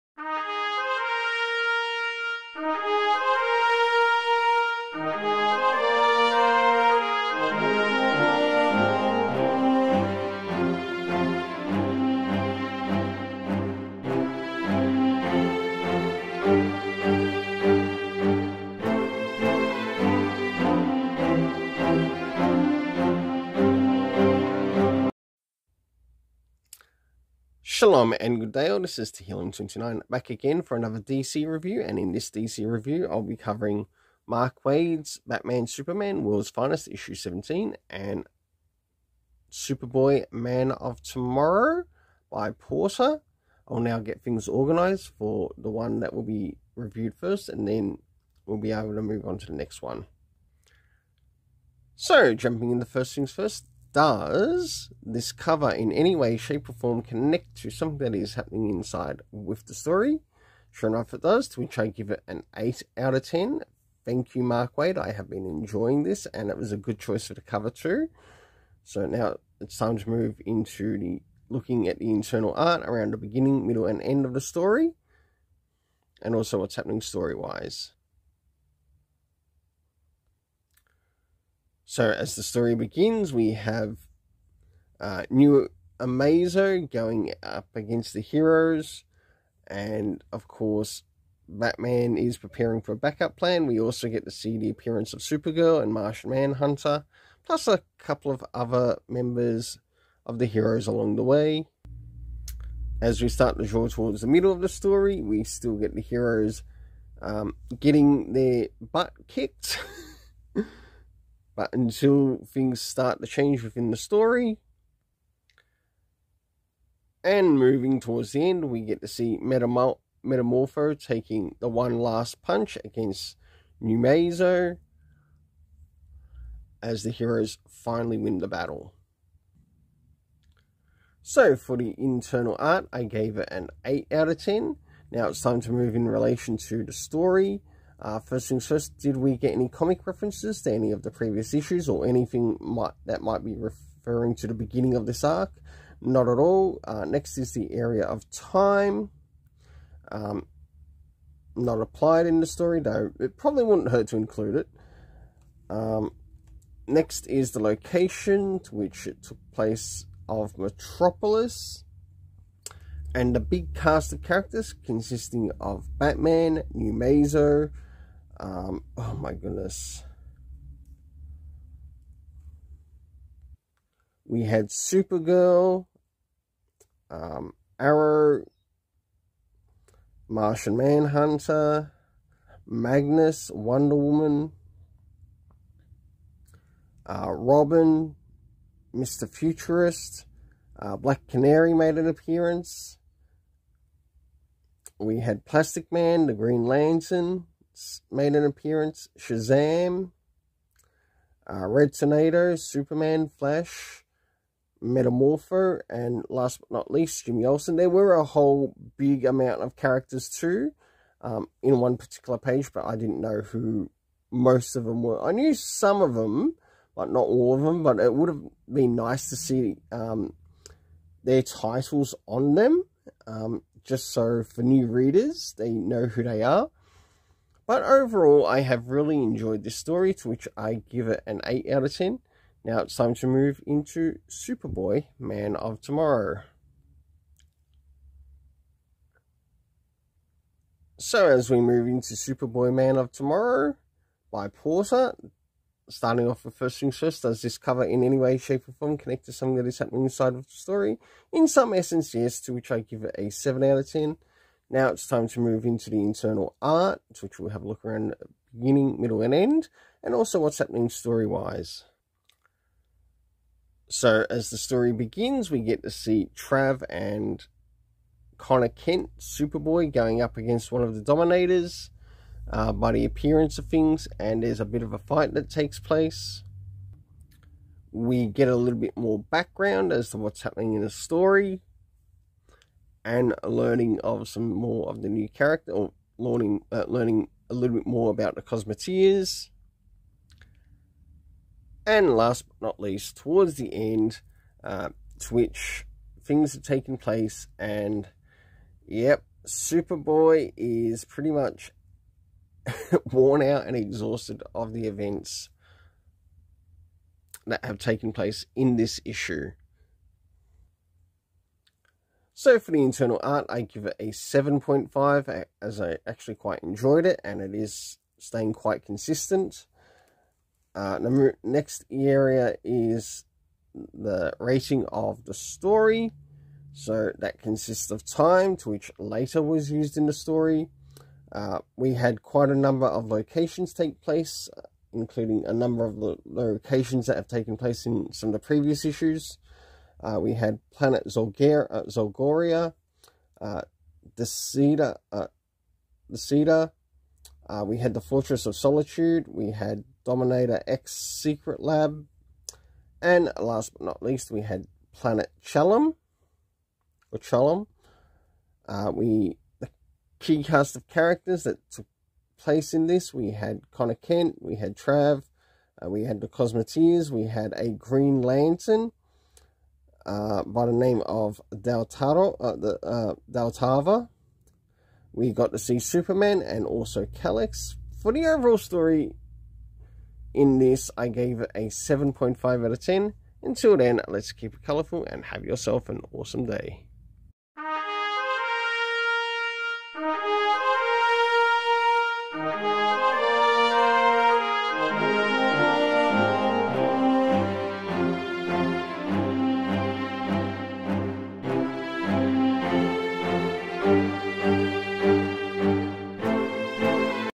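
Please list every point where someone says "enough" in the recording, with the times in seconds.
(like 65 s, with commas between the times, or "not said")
60 s.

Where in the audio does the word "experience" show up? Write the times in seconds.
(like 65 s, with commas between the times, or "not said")
not said.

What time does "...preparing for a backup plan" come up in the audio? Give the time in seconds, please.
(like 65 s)
92 s.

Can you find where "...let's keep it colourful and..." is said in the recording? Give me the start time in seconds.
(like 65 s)
384 s.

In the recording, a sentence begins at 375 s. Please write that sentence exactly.
We got to see Superman and also Calix.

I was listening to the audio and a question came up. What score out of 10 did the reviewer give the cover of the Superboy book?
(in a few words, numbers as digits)
7.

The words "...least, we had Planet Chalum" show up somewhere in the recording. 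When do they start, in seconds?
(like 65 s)
354 s.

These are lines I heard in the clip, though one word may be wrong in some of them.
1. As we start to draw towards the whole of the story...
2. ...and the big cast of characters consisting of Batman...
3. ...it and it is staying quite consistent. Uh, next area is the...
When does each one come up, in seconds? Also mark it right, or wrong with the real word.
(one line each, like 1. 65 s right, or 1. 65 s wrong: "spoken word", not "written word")
1. 103 s wrong: "middle", not "whole"
2. 163 s right
3. 317 s right.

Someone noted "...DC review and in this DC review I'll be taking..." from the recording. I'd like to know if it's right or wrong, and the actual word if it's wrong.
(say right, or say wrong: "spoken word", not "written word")
wrong: "covering", not "taking".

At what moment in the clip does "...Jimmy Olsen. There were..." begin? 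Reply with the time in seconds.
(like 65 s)
207 s.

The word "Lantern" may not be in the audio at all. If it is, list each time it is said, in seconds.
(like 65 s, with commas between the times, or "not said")
196 s, 368 s.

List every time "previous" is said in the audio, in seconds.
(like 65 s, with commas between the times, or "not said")
141 s, 338 s.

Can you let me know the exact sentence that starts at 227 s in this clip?
But overall, I have really enjoyed this story, to which I give it an 8 out of 10.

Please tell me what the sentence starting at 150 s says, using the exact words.
Um, not applied in the story, though it probably wouldn't hurt to include it.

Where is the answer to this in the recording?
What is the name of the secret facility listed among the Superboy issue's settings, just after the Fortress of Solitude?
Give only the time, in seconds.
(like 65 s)
350 s.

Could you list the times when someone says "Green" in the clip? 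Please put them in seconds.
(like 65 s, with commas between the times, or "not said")
196 s, 367 s.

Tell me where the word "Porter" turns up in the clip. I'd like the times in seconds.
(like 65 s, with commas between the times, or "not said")
42 s, 244 s.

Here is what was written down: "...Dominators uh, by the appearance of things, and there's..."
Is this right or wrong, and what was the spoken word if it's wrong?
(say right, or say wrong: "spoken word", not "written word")
right.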